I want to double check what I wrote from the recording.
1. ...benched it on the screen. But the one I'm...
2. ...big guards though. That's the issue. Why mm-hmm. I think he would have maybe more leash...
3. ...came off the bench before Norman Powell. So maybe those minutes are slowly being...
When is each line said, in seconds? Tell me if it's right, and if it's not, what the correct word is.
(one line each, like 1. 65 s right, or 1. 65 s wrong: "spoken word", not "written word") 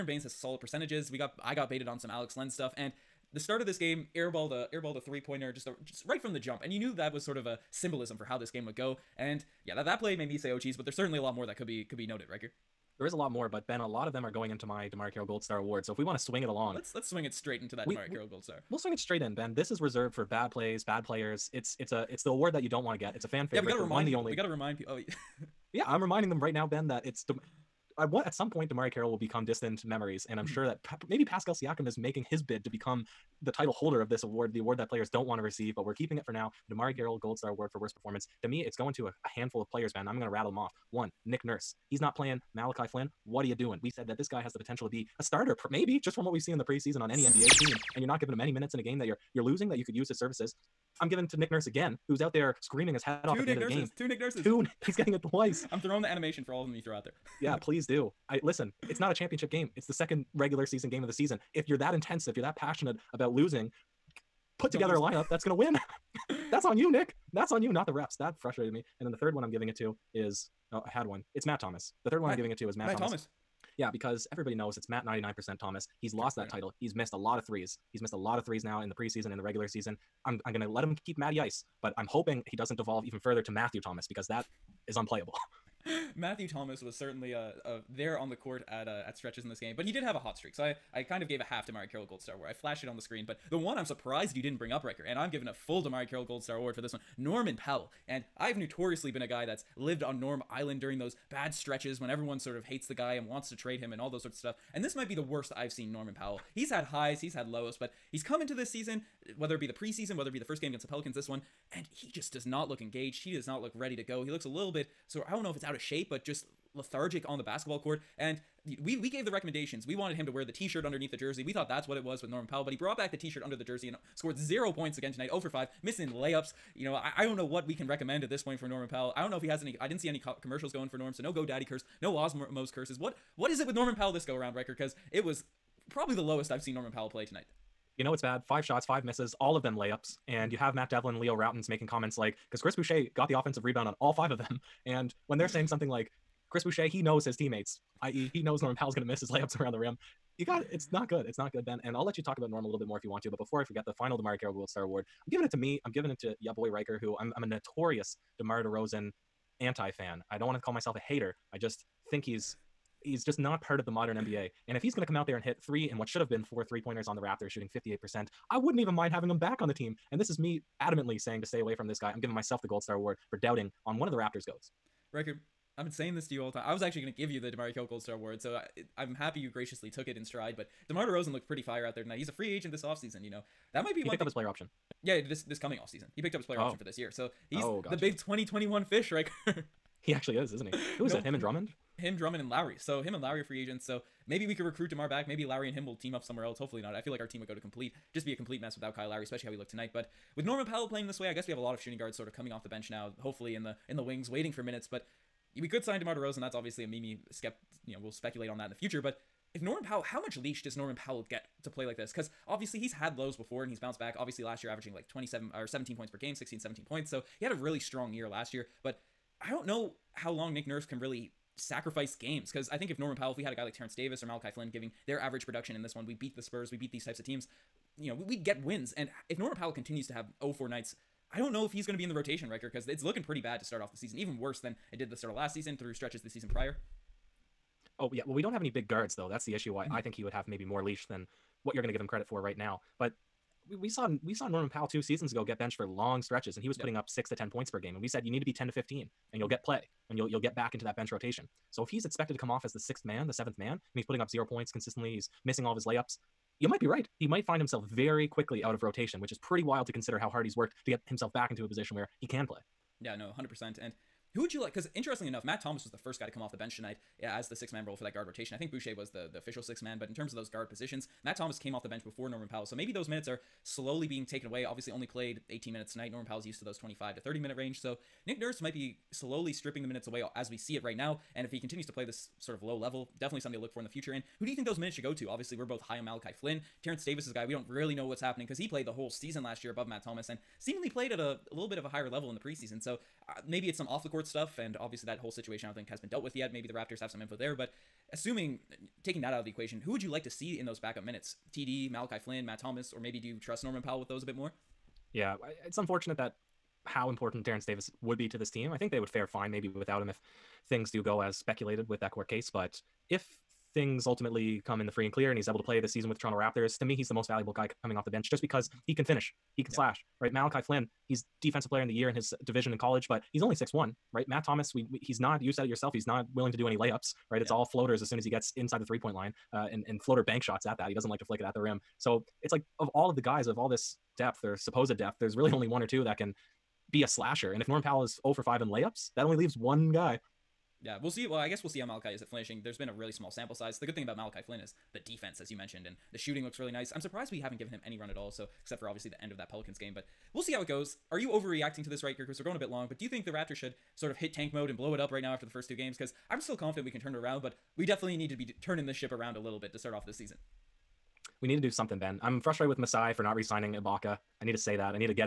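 1. 92 s wrong: "flashed", not "benched"
2. 238 s right
3. 271 s right.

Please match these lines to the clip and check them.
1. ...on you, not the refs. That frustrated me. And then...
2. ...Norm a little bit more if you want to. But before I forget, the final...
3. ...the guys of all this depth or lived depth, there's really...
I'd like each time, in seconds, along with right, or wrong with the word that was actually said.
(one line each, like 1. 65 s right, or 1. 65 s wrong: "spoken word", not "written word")
1. 67 s right
2. 152 s right
3. 333 s wrong: "supposed", not "lived".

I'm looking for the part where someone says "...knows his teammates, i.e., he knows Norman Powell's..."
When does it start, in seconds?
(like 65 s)
147 s.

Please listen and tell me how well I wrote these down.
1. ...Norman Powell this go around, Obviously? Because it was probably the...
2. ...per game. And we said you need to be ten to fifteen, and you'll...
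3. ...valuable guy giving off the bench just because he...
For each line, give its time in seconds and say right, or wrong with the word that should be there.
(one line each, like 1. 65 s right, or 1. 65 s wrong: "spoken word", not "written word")
1. 133 s wrong: "Ryker", not "Obviously"
2. 247 s right
3. 317 s wrong: "coming", not "giving".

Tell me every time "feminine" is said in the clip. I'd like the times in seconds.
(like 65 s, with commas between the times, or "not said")
not said.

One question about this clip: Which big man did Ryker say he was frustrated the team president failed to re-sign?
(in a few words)
Ibaka.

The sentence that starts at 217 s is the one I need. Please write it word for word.
So he had a really strong year last year.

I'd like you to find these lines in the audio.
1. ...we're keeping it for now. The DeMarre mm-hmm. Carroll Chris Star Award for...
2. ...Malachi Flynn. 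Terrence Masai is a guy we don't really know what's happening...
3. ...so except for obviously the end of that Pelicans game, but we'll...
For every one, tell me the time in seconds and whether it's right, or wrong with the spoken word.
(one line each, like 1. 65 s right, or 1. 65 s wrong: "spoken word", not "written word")
1. 35 s wrong: "Gold", not "Chris"
2. 286 s wrong: "Davis", not "Masai"
3. 348 s right.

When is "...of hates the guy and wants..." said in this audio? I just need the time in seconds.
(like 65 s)
102 s.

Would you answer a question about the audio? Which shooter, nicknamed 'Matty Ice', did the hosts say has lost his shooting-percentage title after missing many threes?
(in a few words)
99%.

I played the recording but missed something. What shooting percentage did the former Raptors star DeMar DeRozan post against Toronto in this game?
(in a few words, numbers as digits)
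58%.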